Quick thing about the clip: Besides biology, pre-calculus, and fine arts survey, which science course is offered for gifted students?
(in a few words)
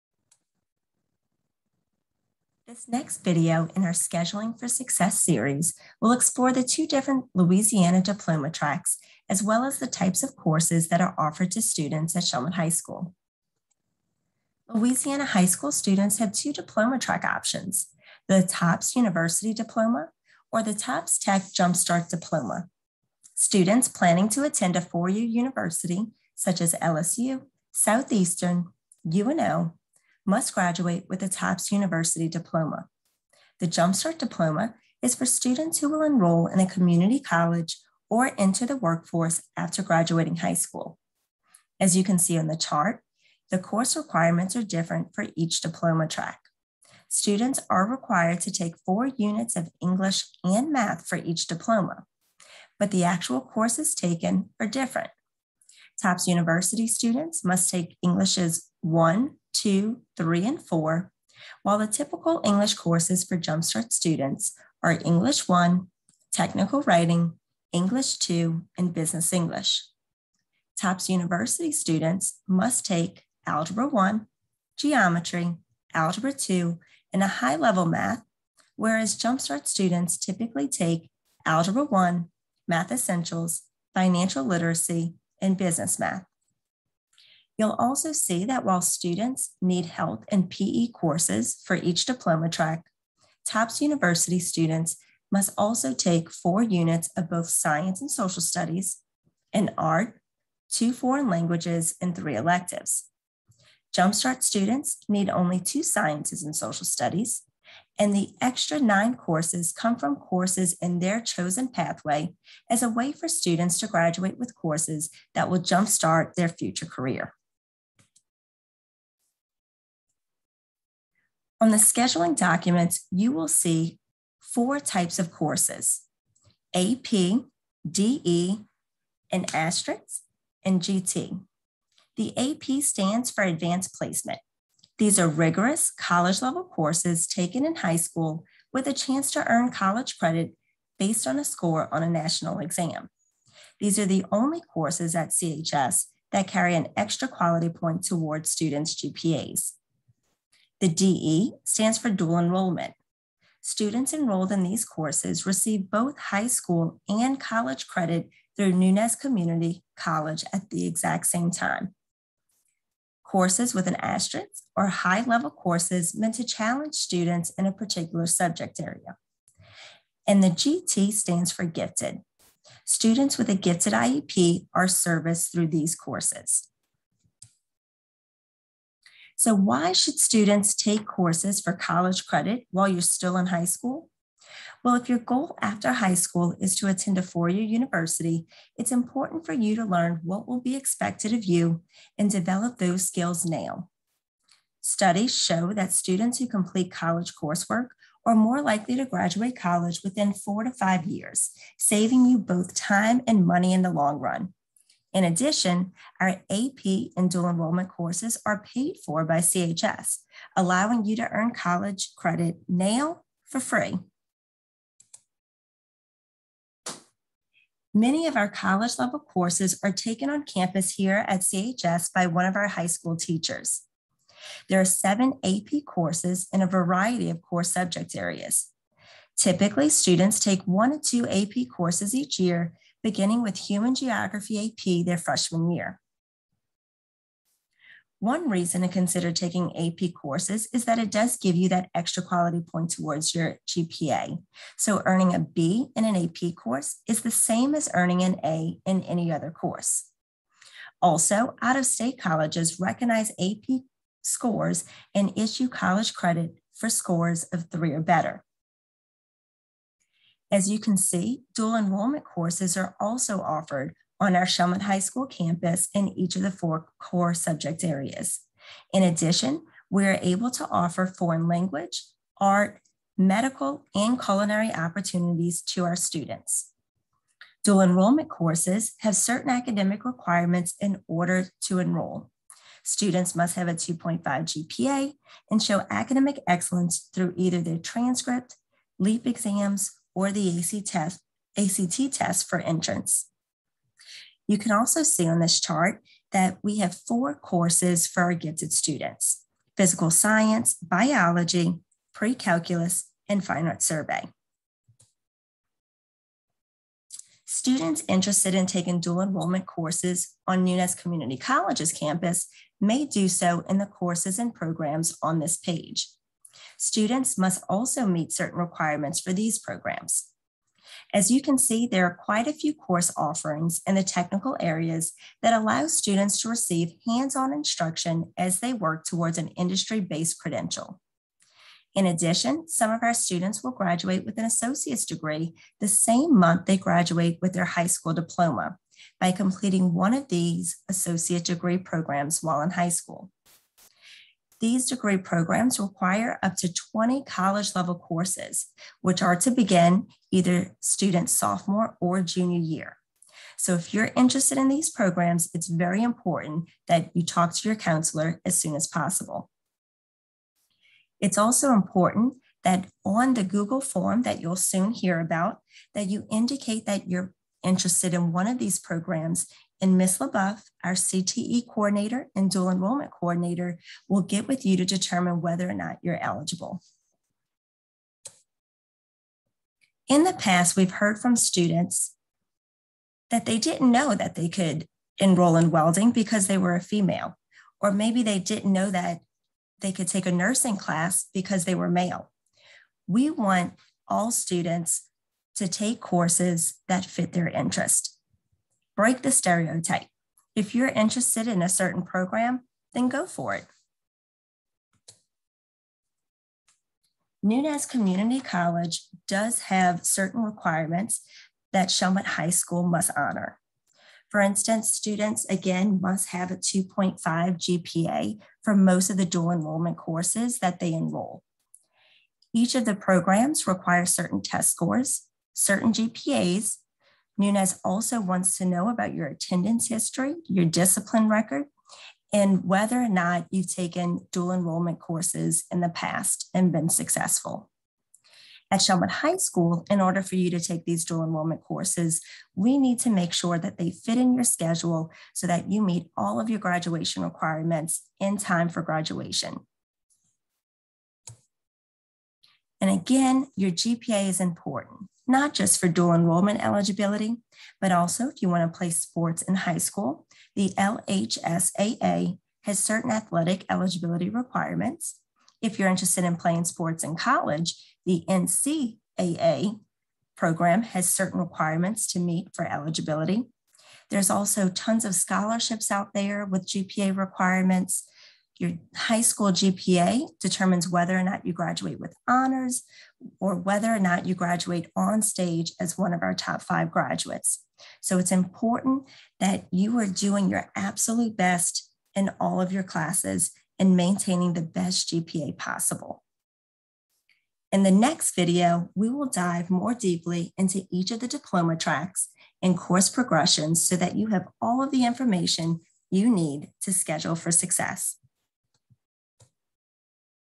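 Physical science.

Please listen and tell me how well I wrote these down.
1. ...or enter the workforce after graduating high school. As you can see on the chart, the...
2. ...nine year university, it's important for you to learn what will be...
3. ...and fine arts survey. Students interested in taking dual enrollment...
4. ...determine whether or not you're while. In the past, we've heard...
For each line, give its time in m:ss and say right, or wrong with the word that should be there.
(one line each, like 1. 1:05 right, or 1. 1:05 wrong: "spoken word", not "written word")
1. 0:38 right
2. 3:07 wrong: "four", not "nine"
3. 5:03 right
4. 6:14 wrong: "eligible", not "while".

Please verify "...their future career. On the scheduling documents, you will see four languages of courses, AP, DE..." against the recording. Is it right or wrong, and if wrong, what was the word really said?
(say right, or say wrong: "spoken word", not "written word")
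wrong: "types", not "languages".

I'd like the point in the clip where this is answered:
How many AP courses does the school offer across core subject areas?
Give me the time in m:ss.
3:44.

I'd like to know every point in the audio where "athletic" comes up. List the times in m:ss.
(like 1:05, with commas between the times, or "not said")
7:43.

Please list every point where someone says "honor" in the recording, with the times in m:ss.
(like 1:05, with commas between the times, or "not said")
6:53, 8:02.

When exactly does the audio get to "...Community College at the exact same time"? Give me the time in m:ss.
2:39.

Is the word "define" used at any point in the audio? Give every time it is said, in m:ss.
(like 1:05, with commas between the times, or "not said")
not said.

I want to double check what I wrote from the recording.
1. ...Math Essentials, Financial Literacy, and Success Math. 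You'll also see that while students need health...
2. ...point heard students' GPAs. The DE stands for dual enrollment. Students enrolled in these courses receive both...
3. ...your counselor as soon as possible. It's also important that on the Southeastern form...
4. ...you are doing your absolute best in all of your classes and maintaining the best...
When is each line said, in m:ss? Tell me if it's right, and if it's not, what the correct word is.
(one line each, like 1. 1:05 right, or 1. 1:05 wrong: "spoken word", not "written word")
1. 1:22 wrong: "Business", not "Success"
2. 2:27 wrong: "toward", not "heard"
3. 5:57 wrong: "Google", not "Southeastern"
4. 8:09 right.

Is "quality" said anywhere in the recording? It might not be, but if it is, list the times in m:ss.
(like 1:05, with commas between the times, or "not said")
2:27, 4:02.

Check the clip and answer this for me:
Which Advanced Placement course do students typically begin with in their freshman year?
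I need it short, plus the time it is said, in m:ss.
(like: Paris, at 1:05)
Human Geography AP, at 3:53.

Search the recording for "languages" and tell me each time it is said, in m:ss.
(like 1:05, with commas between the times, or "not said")
1:41, 4:31.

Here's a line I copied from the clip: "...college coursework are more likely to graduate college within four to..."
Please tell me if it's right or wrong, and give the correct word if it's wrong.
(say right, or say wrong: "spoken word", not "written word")
right.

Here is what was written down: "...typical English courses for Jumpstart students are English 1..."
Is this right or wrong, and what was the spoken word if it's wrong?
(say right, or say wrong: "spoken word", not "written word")
right.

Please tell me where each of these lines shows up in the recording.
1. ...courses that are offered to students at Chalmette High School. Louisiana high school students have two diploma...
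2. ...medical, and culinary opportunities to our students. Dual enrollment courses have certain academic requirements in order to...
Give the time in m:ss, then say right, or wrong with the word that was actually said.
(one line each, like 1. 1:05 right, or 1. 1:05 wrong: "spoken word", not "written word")
1. 0:10 right
2. 4:33 right.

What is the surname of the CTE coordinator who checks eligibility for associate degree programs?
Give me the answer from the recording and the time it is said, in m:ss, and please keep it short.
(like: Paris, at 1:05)
LaBeouf, at 6:10.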